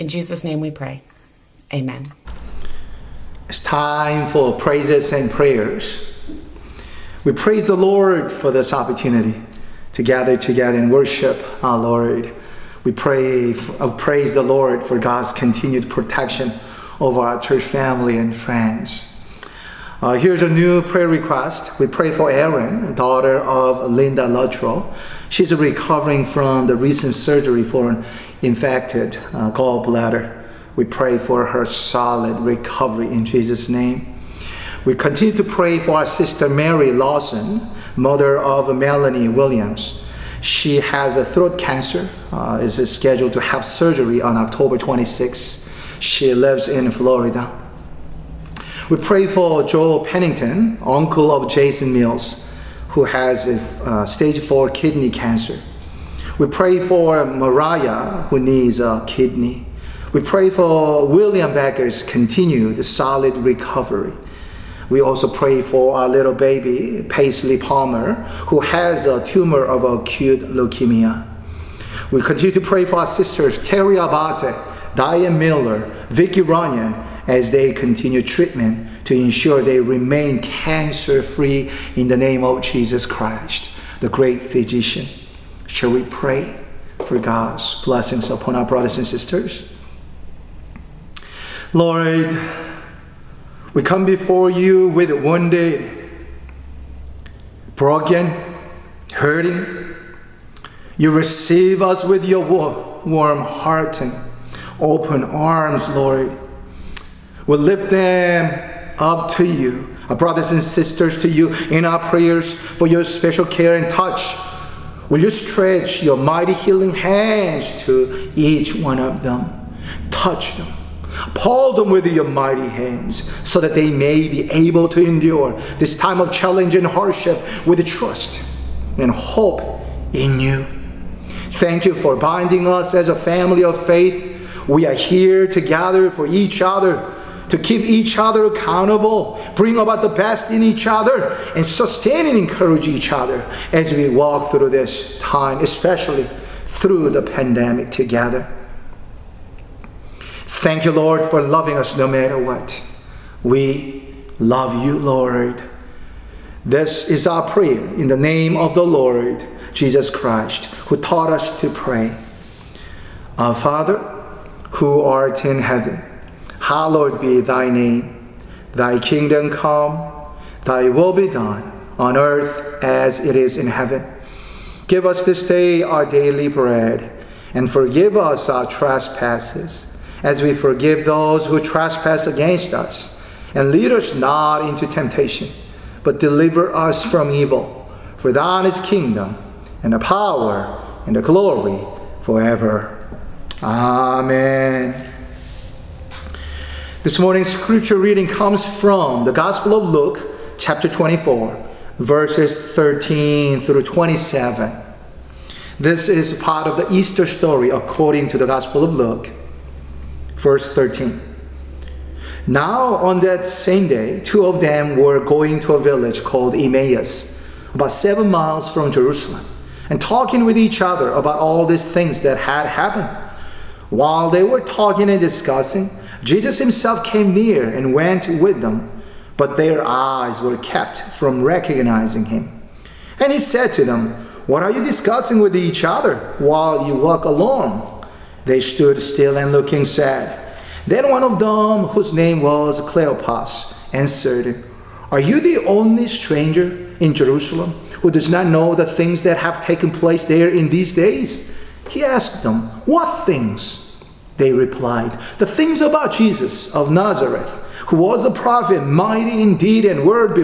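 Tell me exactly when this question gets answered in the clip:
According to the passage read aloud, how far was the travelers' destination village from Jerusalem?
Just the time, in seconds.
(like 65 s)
217 s.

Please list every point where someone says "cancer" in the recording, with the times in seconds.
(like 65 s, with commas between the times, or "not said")
41 s, 55 s, 80 s.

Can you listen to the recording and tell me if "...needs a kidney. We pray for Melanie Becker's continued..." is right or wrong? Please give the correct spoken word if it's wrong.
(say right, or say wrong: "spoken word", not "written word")
wrong: "William", not "Melanie".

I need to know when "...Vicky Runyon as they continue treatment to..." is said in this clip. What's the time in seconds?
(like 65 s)
76 s.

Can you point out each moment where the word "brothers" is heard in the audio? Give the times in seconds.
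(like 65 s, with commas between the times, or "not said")
88 s, 110 s.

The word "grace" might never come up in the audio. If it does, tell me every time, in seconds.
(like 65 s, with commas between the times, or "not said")
not said.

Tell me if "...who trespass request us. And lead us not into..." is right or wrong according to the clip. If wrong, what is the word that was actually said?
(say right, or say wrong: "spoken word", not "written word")
wrong: "against", not "request".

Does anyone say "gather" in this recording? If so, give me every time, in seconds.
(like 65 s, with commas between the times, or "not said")
10 s, 135 s.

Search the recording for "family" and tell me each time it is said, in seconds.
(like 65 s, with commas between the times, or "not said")
17 s, 133 s.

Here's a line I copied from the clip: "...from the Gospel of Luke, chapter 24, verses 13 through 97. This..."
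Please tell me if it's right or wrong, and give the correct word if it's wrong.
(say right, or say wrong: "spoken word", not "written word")
wrong: "27", not "97".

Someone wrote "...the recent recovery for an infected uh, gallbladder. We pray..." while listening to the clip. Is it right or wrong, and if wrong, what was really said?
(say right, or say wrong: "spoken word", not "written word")
wrong: "surgery", not "recovery".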